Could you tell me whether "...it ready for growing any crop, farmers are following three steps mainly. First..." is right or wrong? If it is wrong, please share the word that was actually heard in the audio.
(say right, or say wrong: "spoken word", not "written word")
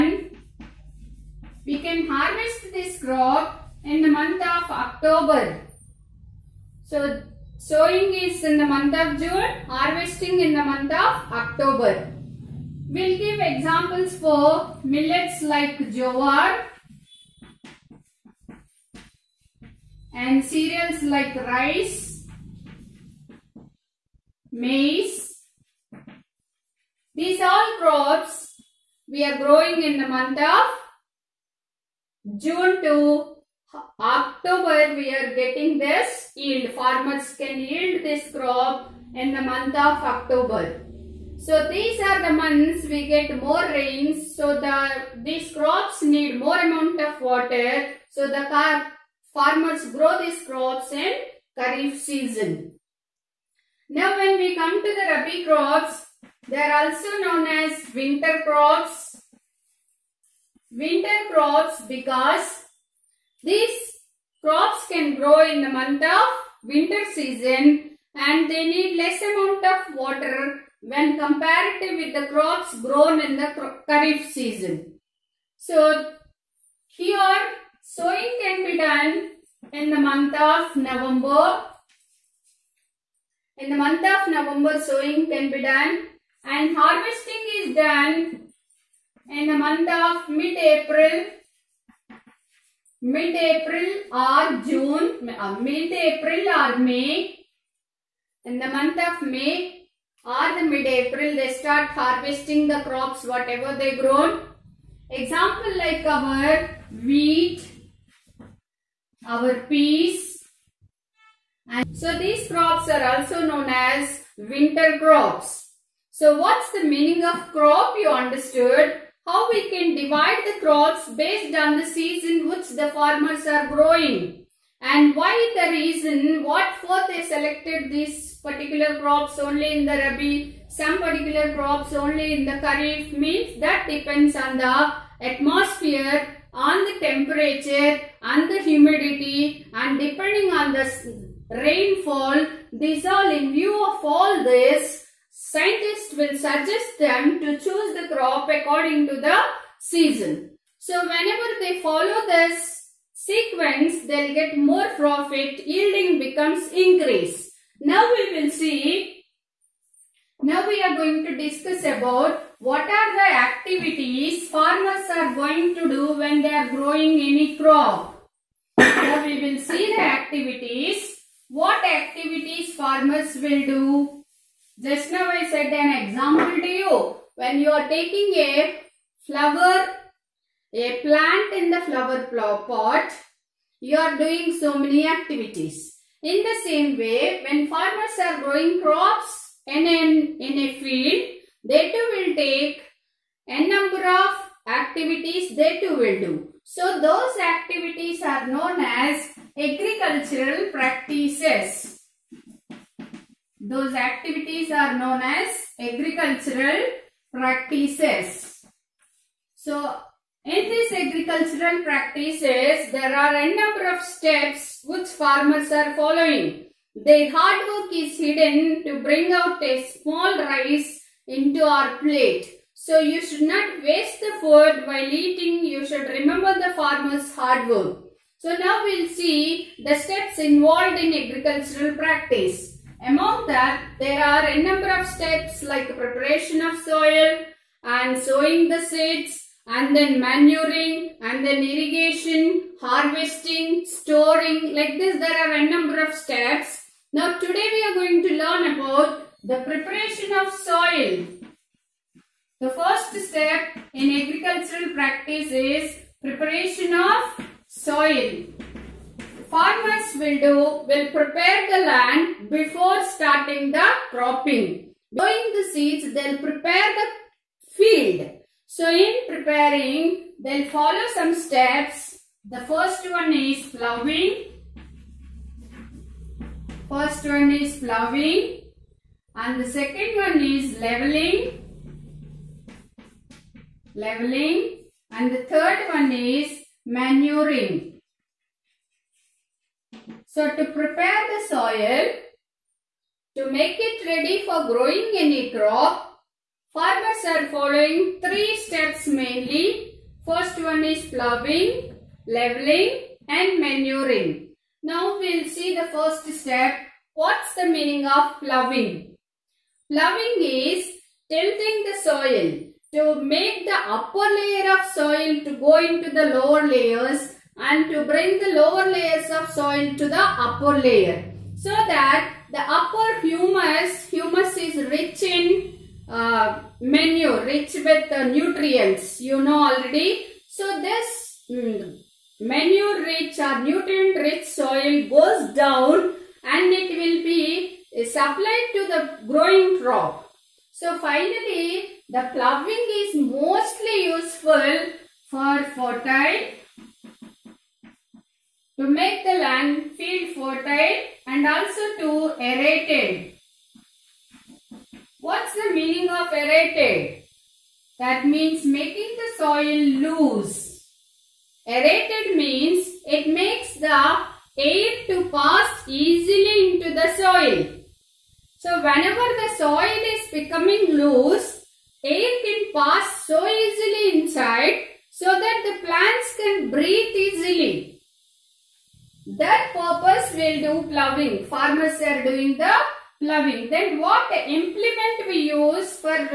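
right.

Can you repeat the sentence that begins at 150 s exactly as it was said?
So whenever they follow this sequence, they'll get more profit, yielding becomes increase.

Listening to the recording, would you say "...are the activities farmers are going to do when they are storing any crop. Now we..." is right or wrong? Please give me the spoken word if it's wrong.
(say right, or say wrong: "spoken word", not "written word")
wrong: "growing", not "storing".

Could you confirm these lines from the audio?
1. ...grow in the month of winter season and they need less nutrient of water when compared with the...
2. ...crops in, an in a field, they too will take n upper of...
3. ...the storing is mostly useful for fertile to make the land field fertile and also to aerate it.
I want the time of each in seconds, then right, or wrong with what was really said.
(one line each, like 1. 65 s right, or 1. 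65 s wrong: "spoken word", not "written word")
1. 65 s wrong: "amount", not "nutrient"
2. 188 s wrong: "number", not "upper"
3. 342 s wrong: "ploughing", not "storing".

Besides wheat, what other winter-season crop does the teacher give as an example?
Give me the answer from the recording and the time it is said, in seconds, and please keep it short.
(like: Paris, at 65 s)
peas, at 109 s.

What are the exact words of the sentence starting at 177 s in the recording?
When you are taking a flower, a plant in the flower pot, you are doing so many activities.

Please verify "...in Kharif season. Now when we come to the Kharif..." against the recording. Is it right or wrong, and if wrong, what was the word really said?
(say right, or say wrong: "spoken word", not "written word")
wrong: "Rabi", not "Kharif".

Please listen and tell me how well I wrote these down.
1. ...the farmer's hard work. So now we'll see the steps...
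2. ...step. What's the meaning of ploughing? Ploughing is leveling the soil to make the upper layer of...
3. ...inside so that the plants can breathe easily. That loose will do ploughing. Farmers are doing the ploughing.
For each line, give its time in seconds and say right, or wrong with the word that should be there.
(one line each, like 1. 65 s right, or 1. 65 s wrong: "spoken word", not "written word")
1. 226 s right
2. 306 s wrong: "tilting", not "leveling"
3. 374 s wrong: "purpose", not "loose".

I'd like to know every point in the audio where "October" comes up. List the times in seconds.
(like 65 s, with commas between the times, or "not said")
4 s, 11 s, 33 s, 40 s.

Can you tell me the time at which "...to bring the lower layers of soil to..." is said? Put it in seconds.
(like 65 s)
317 s.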